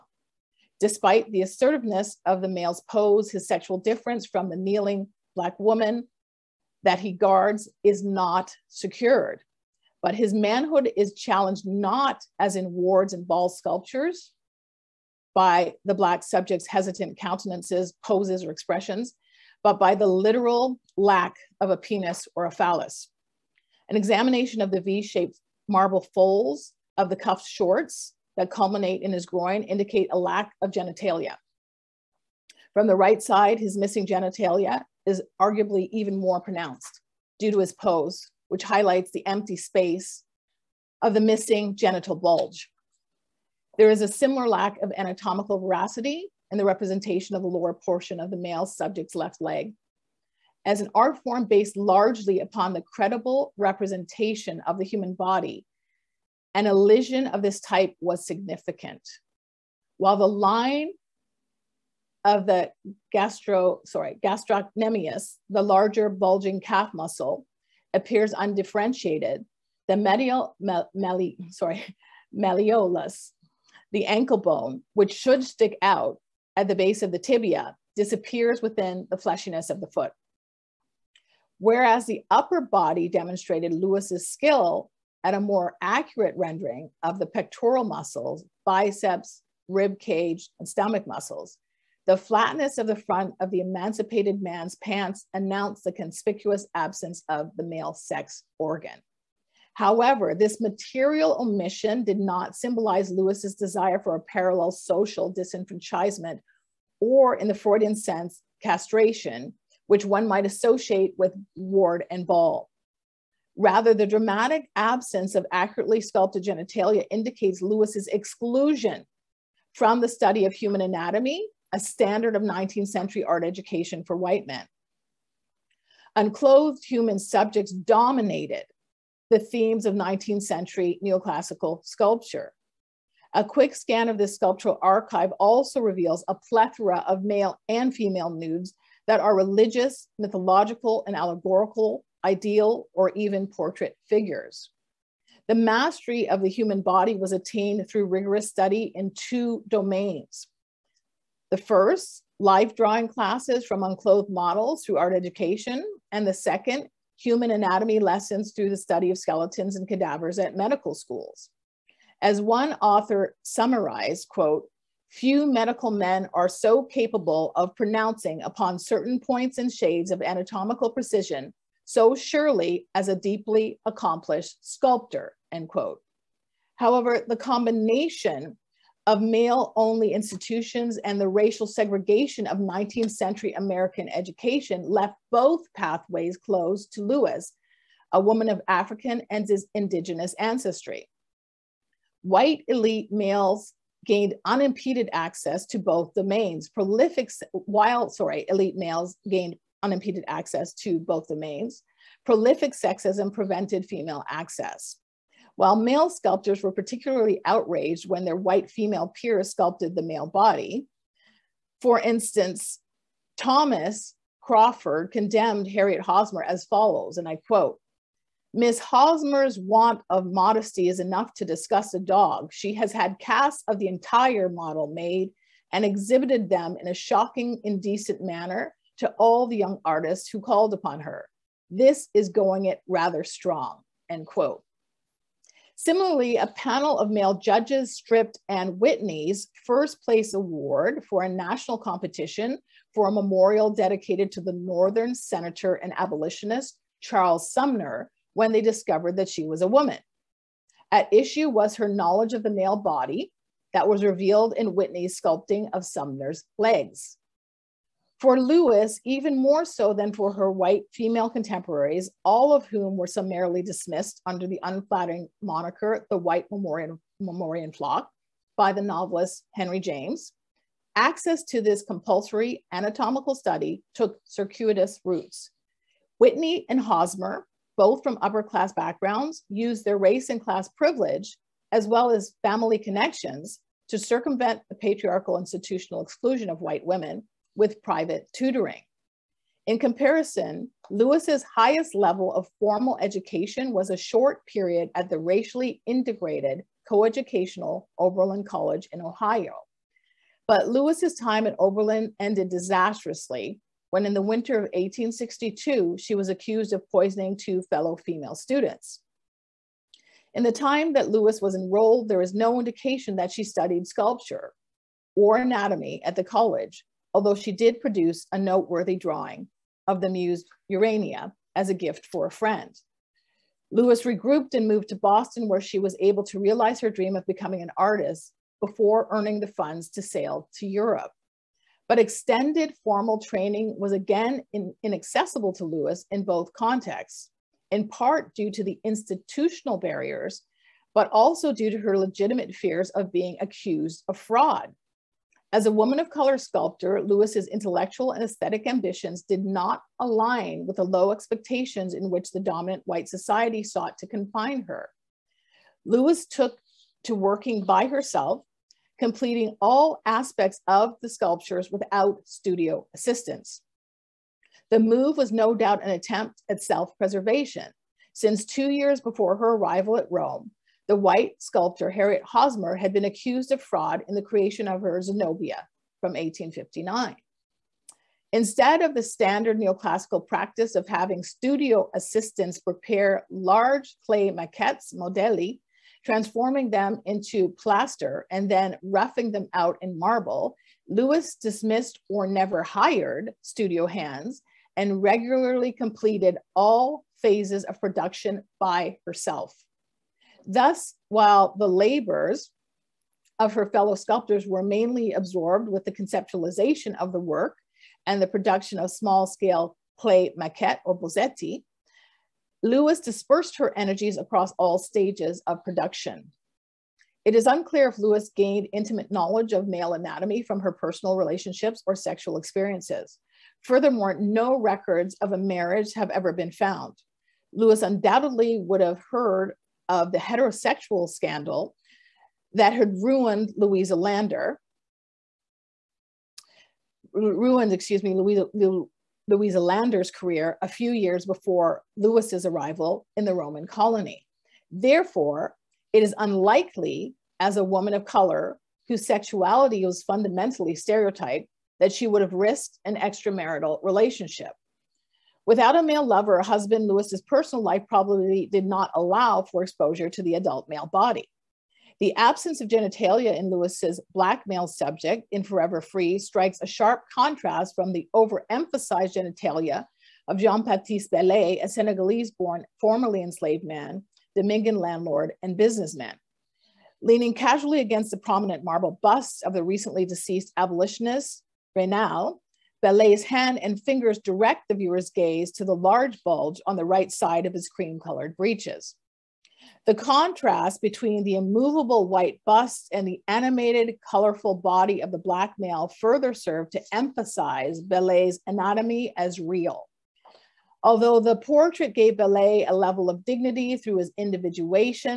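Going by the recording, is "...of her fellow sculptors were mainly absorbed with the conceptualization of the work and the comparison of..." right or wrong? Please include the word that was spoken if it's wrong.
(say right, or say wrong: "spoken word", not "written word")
wrong: "production", not "comparison".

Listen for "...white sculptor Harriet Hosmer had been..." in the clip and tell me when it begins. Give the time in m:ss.
6:10.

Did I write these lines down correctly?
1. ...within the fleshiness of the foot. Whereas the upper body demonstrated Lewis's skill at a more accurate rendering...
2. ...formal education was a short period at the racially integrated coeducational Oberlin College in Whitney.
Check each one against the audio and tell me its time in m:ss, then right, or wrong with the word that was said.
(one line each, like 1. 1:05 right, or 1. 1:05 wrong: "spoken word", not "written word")
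1. 1:18 right
2. 4:52 wrong: "Ohio", not "Whitney".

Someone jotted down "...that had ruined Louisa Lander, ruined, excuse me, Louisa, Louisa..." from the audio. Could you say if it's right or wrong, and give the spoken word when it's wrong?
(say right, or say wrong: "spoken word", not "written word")
right.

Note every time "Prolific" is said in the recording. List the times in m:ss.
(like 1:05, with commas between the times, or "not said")
3:16, 3:22.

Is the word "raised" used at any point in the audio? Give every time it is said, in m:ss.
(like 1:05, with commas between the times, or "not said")
not said.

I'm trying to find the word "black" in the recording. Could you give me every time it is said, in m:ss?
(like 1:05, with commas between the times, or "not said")
0:05, 0:15, 7:44, 8:15.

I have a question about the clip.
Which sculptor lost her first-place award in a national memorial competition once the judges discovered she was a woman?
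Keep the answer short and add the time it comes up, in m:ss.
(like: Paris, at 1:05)
Anne Whitney, at 3:58.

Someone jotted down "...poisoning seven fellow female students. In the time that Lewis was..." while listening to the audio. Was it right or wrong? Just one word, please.
wrong.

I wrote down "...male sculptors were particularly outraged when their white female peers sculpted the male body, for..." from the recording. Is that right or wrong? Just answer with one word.
right.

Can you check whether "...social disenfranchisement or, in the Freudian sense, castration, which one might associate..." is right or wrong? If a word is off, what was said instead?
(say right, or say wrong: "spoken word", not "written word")
right.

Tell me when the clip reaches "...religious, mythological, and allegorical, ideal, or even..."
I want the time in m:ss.
2:19.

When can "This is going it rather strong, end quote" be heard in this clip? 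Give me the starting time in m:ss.
3:51.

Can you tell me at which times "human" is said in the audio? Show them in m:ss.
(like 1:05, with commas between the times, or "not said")
0:54, 2:00, 2:06, 2:26, 2:37.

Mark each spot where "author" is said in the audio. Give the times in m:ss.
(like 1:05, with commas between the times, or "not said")
2:42.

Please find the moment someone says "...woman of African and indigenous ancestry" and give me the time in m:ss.
3:08.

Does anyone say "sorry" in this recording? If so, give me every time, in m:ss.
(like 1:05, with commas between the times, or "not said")
1:03, 1:11, 3:18.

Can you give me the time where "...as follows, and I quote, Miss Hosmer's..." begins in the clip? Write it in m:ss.
3:36.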